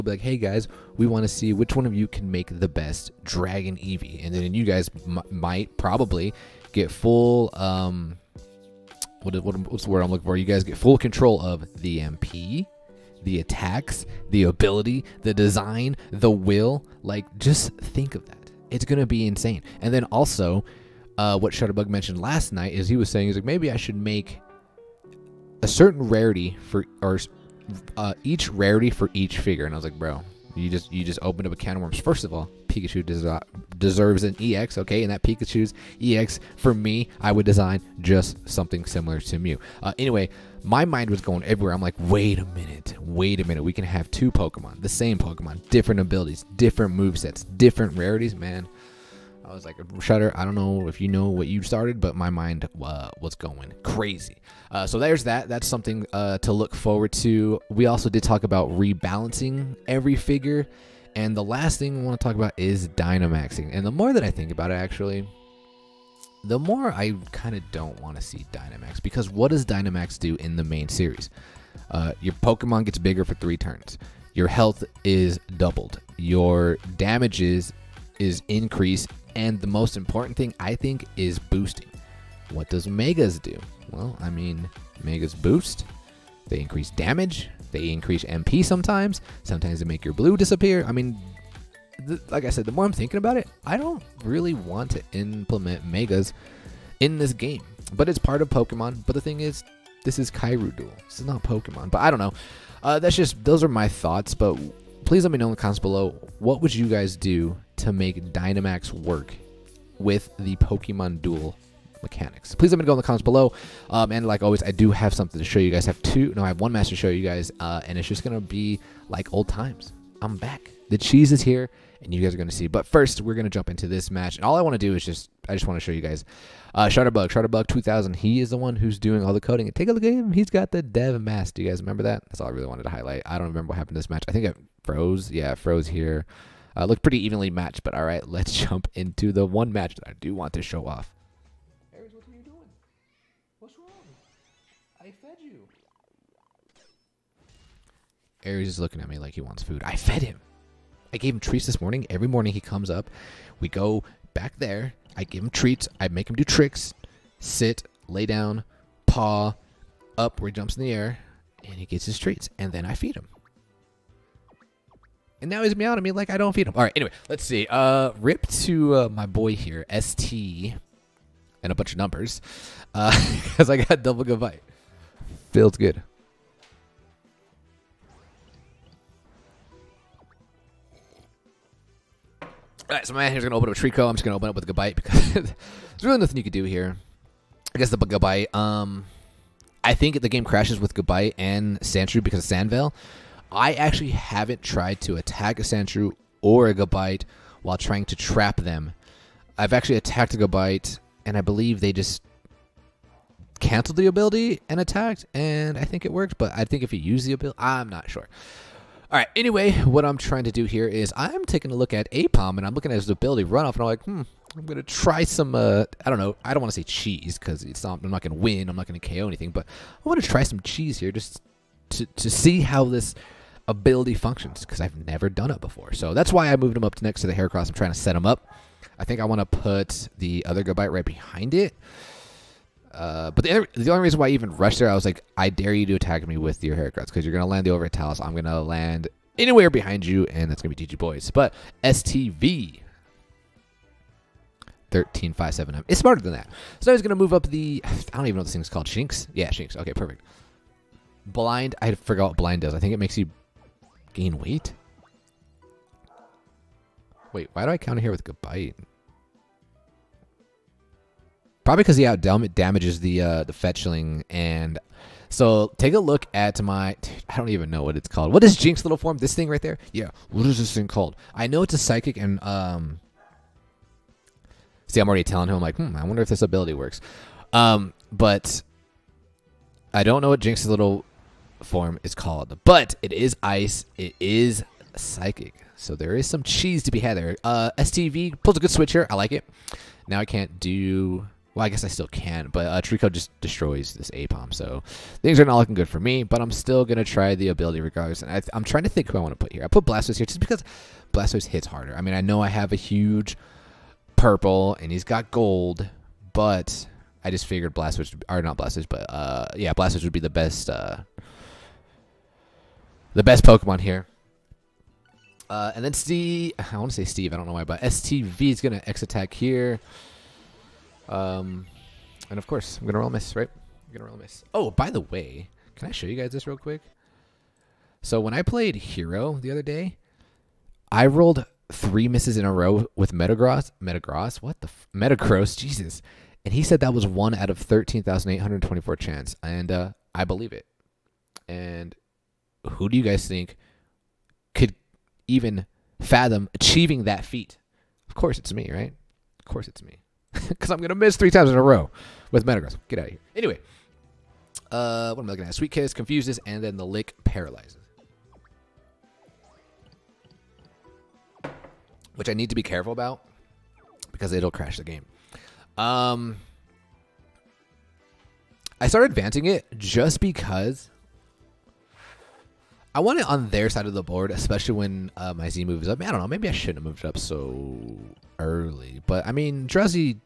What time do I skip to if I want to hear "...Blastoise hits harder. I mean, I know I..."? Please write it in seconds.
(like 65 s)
301 s.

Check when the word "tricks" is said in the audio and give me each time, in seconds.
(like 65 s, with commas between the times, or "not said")
156 s.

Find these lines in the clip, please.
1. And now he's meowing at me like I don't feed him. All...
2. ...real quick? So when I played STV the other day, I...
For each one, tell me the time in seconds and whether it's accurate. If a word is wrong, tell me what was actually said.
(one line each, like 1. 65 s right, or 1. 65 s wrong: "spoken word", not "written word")
1. 165 s right
2. 326 s wrong: "Hero", not "STV".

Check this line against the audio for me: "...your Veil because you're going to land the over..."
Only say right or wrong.
wrong.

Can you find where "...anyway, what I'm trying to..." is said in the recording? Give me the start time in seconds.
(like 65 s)
209 s.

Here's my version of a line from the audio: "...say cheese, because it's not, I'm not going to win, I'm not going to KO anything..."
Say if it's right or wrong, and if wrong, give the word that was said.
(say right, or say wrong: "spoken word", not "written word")
right.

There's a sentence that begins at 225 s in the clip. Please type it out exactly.
So that's why I moved him up to next to the Heracross.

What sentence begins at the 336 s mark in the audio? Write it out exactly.
And he said that was one out of thirteen thousand eight hundred twenty-four chance, and uh, I believe it.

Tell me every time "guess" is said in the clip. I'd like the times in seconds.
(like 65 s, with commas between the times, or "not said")
187 s, 291 s.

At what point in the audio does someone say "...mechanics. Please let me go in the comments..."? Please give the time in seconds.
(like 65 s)
112 s.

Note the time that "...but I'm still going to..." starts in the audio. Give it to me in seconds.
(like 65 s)
296 s.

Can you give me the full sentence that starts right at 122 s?
But first, we're going to jump into this match.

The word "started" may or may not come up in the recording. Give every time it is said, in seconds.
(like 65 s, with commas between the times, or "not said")
51 s, 368 s.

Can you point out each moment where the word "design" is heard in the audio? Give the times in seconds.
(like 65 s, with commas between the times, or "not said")
15 s, 37 s.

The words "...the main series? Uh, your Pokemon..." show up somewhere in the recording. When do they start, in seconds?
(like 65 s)
70 s.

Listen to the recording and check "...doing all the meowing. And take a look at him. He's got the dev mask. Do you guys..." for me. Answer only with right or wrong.
wrong.